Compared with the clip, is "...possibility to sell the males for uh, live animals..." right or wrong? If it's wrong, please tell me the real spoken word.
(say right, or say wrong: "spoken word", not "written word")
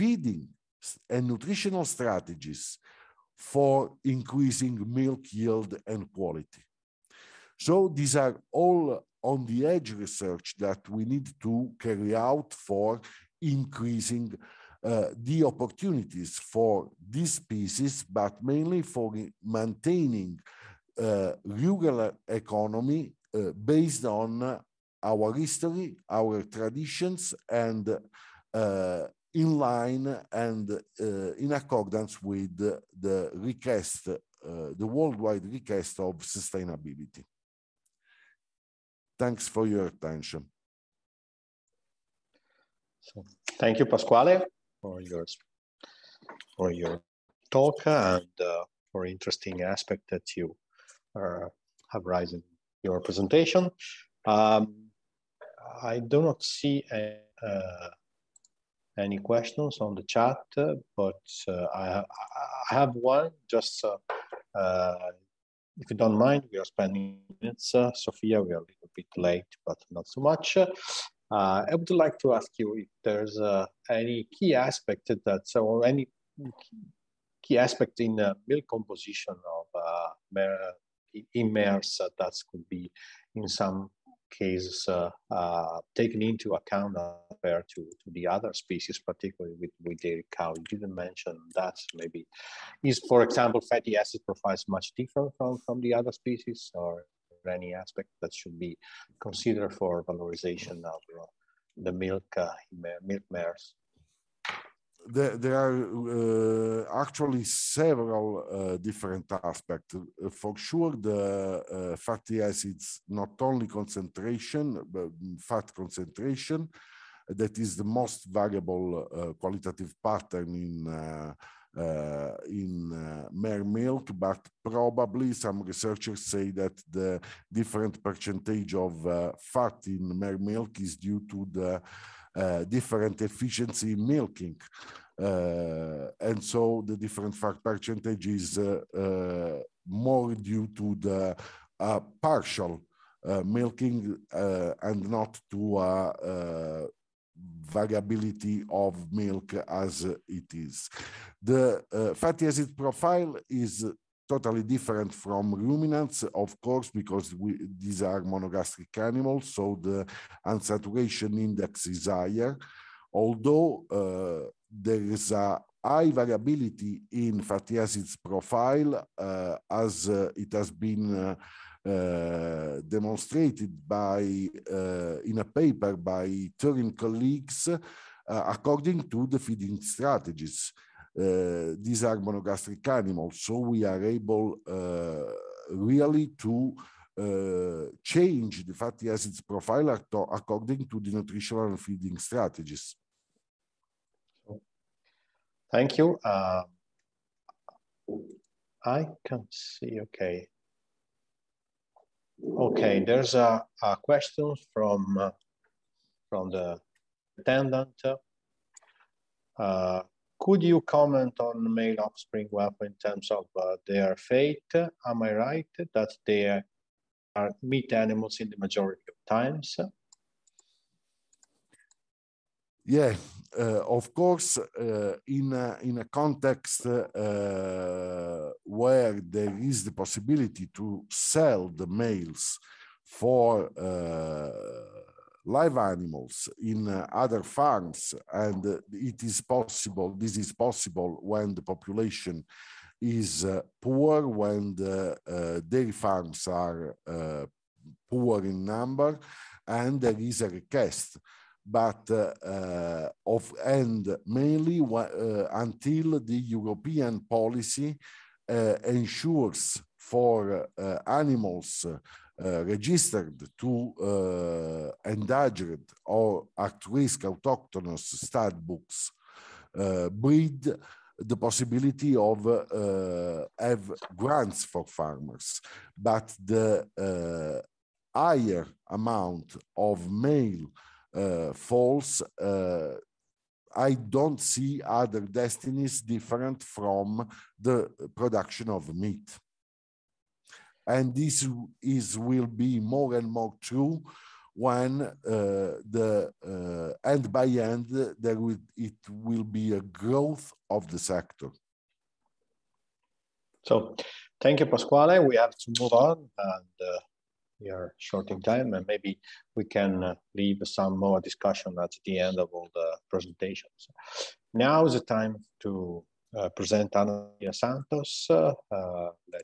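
right.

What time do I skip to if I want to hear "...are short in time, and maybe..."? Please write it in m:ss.
5:07.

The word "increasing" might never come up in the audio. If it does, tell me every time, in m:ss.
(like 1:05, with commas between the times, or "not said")
0:04, 0:13.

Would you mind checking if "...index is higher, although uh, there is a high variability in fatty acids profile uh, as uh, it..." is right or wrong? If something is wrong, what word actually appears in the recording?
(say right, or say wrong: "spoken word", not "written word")
right.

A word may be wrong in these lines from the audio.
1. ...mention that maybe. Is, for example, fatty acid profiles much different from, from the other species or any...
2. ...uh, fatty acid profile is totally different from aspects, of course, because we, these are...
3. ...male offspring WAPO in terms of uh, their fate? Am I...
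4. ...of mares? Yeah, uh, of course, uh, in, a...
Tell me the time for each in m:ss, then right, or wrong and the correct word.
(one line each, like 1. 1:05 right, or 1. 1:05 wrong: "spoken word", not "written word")
1. 1:30 right
2. 2:31 wrong: "ruminants", not "aspects"
3. 3:31 right
4. 3:39 wrong: "times", not "mares".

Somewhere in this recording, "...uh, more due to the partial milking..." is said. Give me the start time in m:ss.
2:18.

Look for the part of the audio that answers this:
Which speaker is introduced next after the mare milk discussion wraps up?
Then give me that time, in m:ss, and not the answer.
5:16.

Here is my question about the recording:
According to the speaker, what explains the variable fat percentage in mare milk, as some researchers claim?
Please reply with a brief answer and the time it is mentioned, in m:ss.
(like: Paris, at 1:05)
Different efficiency in milking, at 2:12.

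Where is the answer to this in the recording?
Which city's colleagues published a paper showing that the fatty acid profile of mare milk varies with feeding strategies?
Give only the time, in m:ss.
2:56.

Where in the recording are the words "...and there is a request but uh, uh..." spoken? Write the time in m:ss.
4:09.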